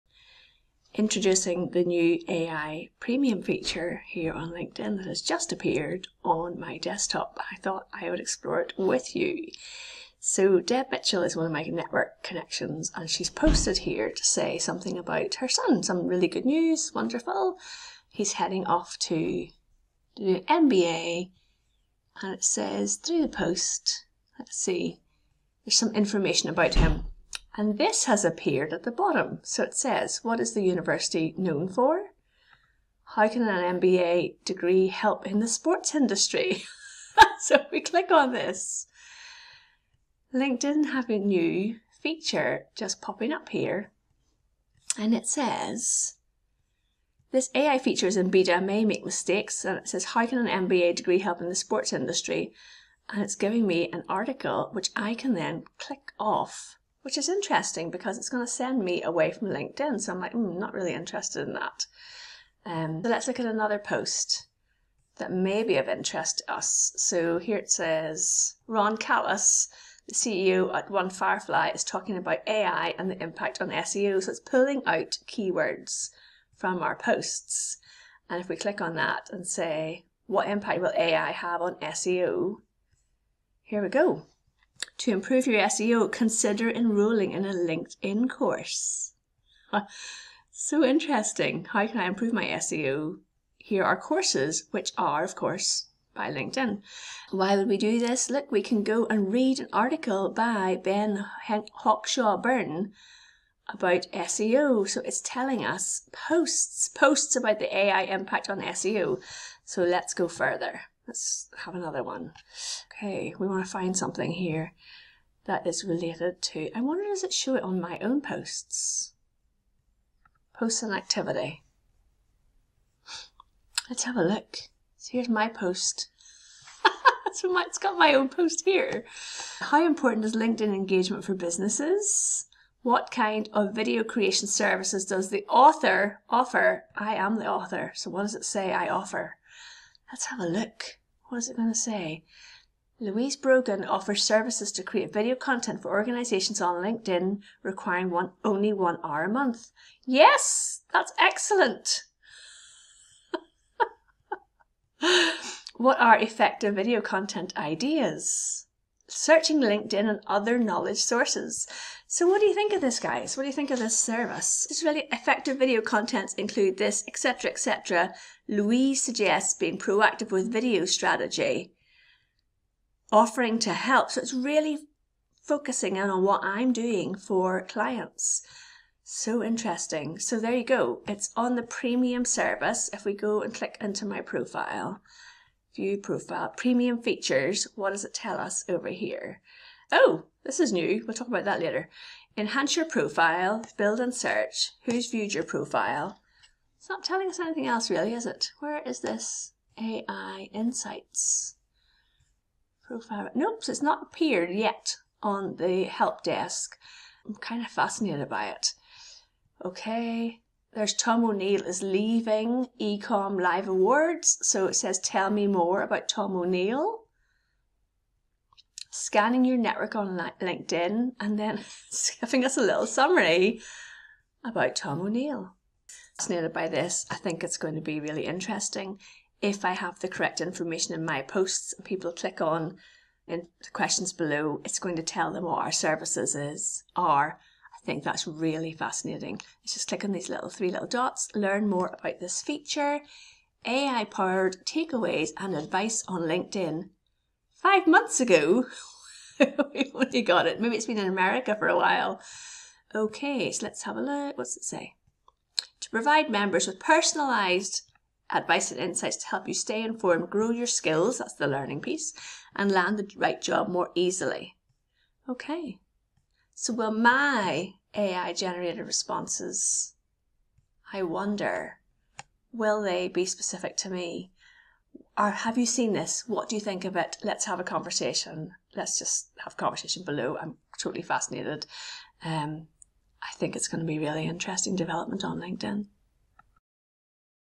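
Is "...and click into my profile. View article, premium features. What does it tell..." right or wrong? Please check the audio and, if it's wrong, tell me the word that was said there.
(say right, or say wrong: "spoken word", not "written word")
wrong: "profile", not "article".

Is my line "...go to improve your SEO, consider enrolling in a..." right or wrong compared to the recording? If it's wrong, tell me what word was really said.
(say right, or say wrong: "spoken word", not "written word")
right.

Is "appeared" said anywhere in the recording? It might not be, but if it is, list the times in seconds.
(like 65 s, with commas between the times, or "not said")
5 s, 28 s, 204 s.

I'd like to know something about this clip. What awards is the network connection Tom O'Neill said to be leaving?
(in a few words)
Ecom Live Awards.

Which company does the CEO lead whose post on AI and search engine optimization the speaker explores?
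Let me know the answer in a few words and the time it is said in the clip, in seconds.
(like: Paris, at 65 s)
One Firefly, at 70 s.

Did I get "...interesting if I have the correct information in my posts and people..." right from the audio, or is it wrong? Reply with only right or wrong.
right.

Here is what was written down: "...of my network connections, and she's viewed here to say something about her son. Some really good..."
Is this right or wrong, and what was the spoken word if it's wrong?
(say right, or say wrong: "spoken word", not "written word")
wrong: "posted", not "viewed".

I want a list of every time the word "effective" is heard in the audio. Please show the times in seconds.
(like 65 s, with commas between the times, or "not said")
156 s, 165 s.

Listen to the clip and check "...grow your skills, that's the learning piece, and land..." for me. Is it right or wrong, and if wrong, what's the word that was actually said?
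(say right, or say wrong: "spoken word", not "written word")
right.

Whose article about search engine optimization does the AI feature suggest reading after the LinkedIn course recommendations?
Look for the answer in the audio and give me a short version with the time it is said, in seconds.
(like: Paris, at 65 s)
Ben Hawkshaw Byrne, at 100 s.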